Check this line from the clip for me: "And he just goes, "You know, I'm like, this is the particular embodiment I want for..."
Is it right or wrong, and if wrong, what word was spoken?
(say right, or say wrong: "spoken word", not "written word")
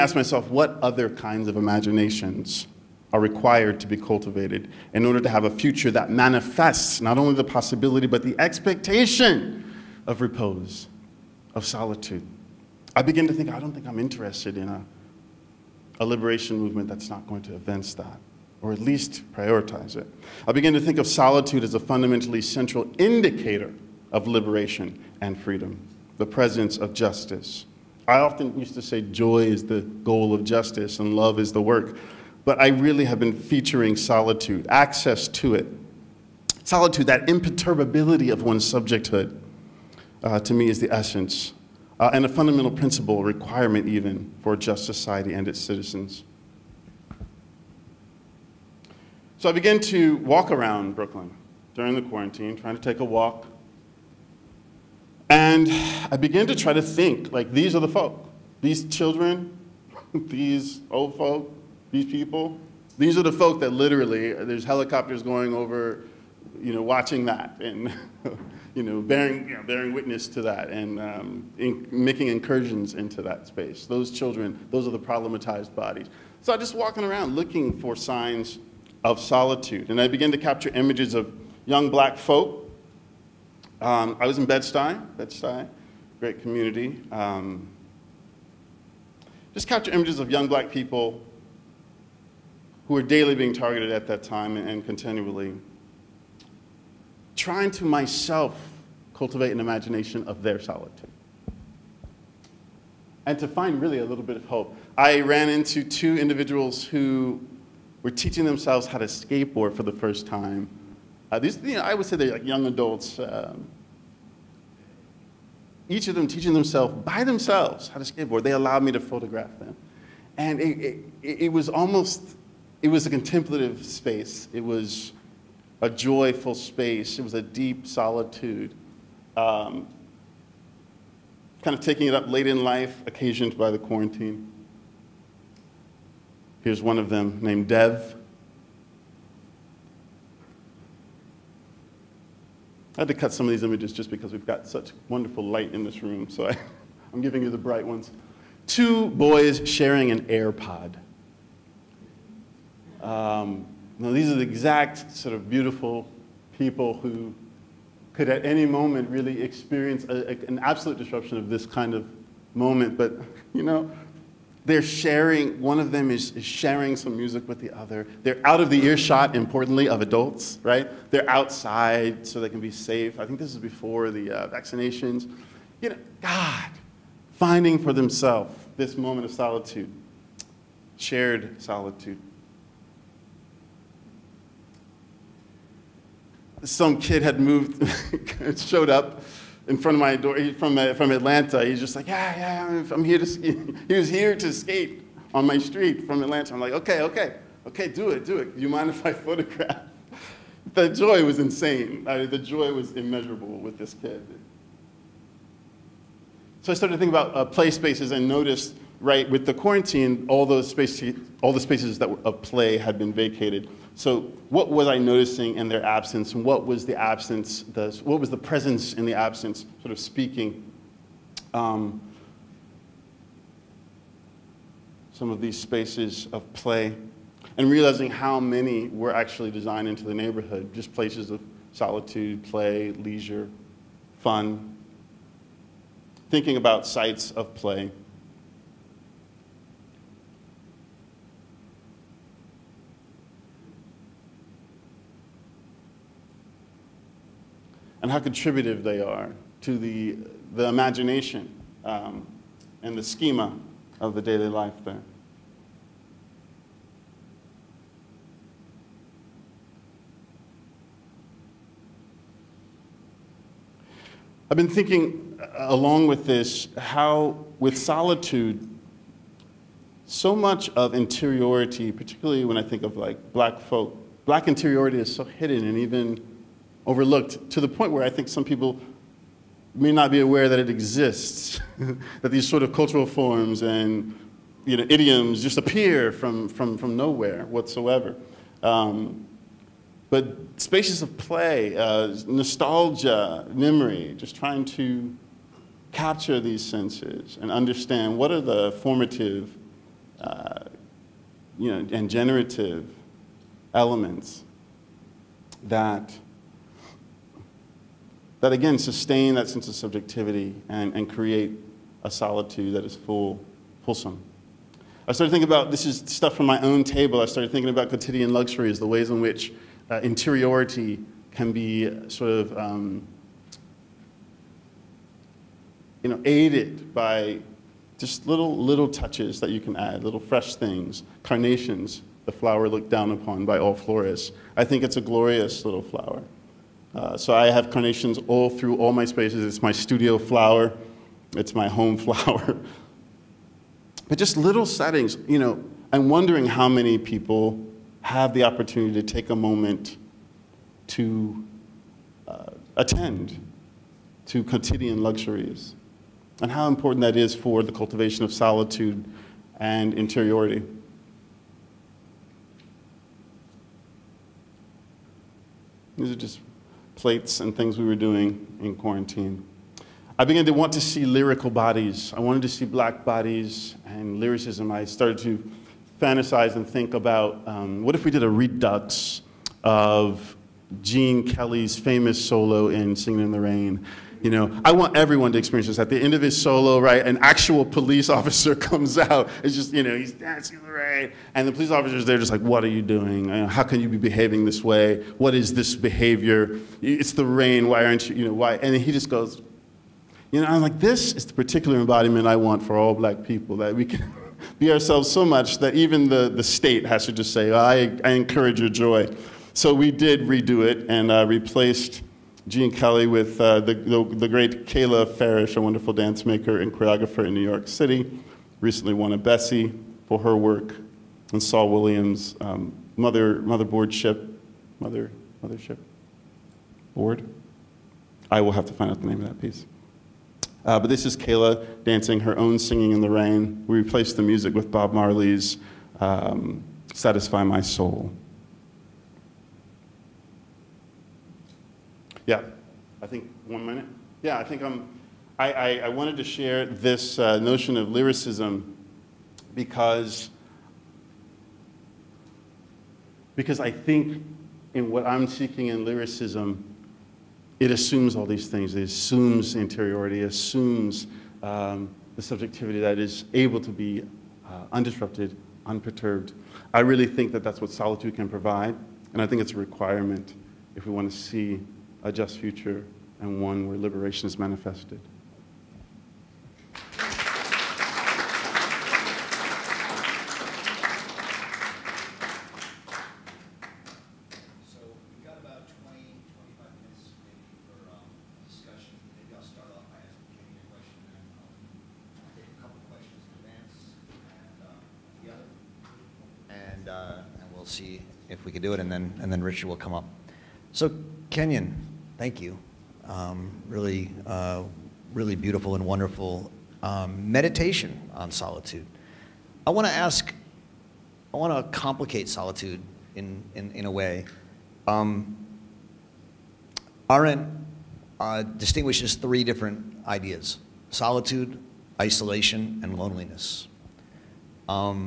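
right.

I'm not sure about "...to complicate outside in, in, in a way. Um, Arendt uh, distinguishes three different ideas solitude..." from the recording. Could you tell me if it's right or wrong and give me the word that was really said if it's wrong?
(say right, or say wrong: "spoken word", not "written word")
wrong: "solitude", not "outside".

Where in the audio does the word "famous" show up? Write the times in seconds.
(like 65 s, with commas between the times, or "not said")
381 s.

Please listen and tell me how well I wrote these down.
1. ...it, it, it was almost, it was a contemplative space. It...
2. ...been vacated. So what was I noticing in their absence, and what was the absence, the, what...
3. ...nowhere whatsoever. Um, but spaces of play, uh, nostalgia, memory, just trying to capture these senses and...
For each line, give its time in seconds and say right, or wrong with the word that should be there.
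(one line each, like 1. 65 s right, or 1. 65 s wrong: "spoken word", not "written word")
1. 120 s right
2. 212 s right
3. 286 s right.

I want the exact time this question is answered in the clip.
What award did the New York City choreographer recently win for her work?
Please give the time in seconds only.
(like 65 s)
419 s.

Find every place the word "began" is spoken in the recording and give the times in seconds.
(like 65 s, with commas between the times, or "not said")
49 s, 56 s, 80 s, 370 s.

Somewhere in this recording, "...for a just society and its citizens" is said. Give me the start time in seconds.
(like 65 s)
44 s.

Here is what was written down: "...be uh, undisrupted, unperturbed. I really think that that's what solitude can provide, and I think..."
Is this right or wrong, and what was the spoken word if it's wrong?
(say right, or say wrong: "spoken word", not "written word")
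right.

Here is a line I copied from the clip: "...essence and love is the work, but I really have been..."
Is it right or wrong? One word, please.
wrong.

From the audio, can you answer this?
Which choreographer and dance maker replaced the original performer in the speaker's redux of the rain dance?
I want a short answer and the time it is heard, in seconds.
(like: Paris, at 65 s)
Kayla Farrish, at 414 s.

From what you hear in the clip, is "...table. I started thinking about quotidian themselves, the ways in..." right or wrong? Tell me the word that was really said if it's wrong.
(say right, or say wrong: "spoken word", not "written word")
wrong: "luxuries", not "themselves".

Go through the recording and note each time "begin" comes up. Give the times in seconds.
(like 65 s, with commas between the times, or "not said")
13 s, 20 s.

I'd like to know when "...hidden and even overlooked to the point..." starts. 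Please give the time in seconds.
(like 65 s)
275 s.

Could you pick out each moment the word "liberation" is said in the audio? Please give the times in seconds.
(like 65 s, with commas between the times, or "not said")
16 s, 24 s.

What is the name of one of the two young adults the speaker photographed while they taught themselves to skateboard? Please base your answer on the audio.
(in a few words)
Dev.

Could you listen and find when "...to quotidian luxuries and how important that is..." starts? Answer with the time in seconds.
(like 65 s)
354 s.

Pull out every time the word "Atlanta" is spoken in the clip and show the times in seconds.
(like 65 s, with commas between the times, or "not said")
191 s, 196 s.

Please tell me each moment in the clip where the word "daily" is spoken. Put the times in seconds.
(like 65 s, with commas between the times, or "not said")
93 s, 254 s.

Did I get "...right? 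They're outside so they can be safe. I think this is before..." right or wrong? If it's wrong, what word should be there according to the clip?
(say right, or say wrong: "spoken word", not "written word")
right.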